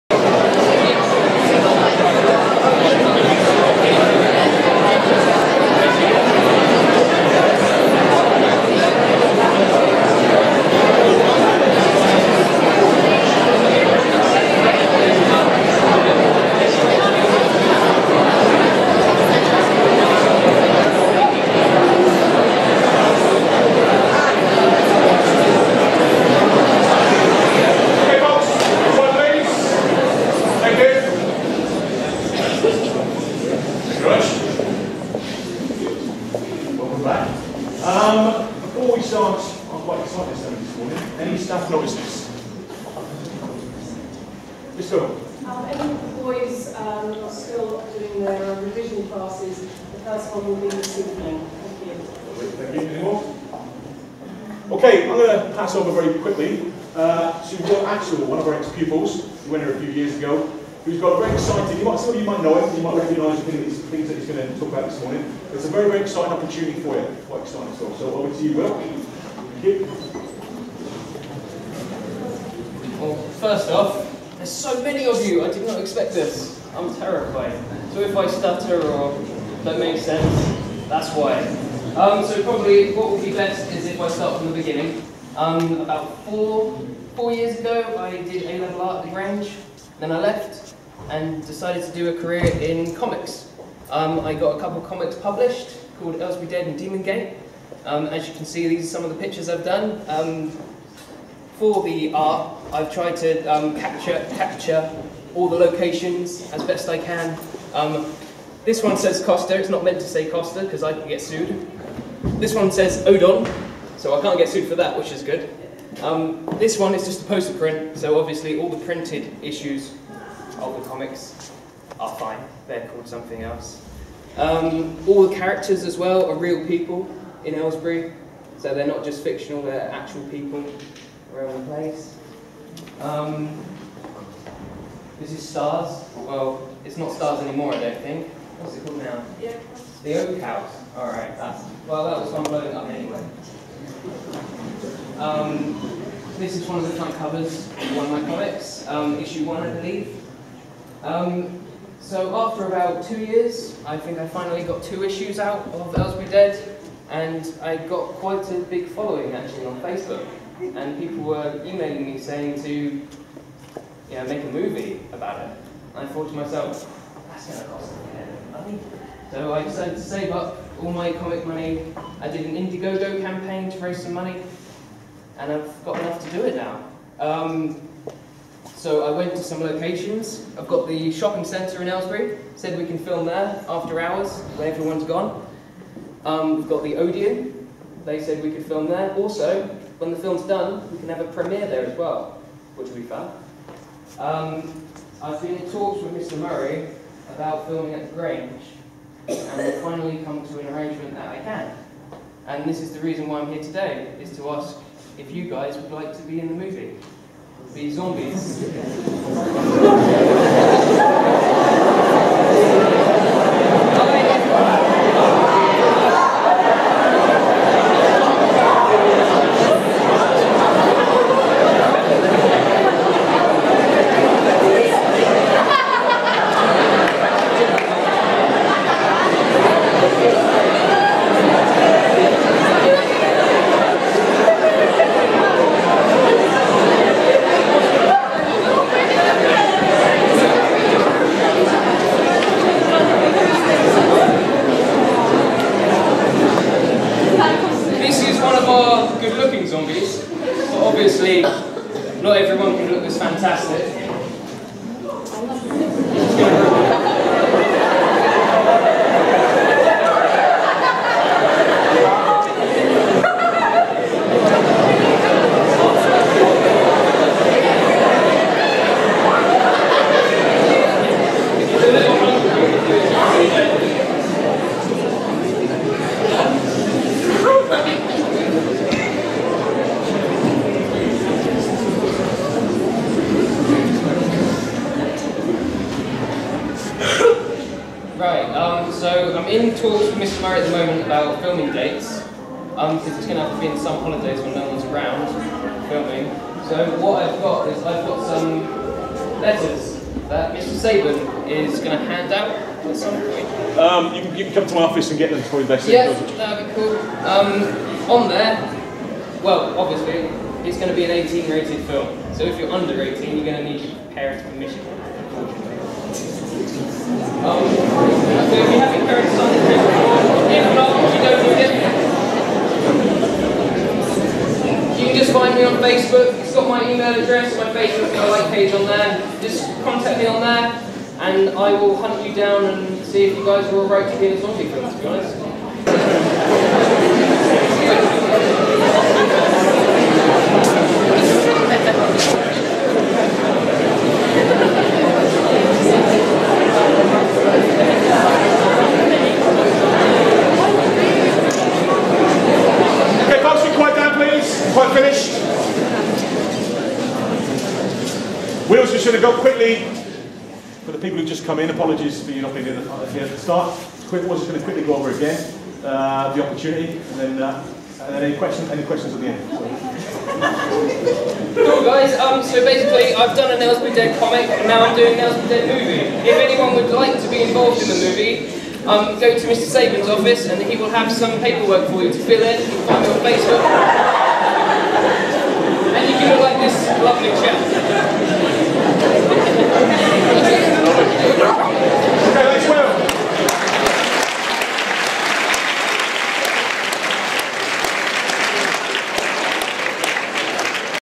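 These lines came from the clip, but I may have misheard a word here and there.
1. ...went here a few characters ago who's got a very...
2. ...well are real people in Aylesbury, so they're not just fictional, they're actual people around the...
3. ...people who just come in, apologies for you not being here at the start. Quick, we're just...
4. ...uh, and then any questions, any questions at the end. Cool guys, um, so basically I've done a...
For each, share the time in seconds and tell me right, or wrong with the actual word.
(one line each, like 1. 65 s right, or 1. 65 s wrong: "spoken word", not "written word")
1. 59 s wrong: "years", not "characters"
2. 125 s right
3. 360 s right
4. 367 s right.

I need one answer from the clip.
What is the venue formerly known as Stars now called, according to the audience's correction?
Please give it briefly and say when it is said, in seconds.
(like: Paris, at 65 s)
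The Oak House, at 140 s.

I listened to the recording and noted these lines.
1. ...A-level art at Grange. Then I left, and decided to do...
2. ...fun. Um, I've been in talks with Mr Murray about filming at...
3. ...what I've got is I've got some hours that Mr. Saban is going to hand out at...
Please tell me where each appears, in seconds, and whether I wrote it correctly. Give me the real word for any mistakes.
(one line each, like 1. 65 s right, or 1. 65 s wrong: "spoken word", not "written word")
1. 88 s right
2. 193 s right
3. 296 s wrong: "letters", not "hours".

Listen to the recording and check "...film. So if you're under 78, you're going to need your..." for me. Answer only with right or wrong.
wrong.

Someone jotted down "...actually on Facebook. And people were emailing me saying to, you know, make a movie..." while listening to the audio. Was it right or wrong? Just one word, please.
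right.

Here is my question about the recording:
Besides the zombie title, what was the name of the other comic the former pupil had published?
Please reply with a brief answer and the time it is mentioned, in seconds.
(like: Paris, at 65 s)
Demon Gate, at 96 s.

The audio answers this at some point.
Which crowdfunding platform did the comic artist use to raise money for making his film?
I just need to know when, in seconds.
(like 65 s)
172 s.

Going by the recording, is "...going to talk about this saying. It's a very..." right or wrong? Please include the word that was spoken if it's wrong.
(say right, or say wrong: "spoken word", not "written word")
wrong: "morning", not "saying".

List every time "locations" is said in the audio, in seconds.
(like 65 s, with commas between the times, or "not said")
105 s, 179 s.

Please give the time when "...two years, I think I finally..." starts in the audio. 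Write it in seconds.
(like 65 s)
153 s.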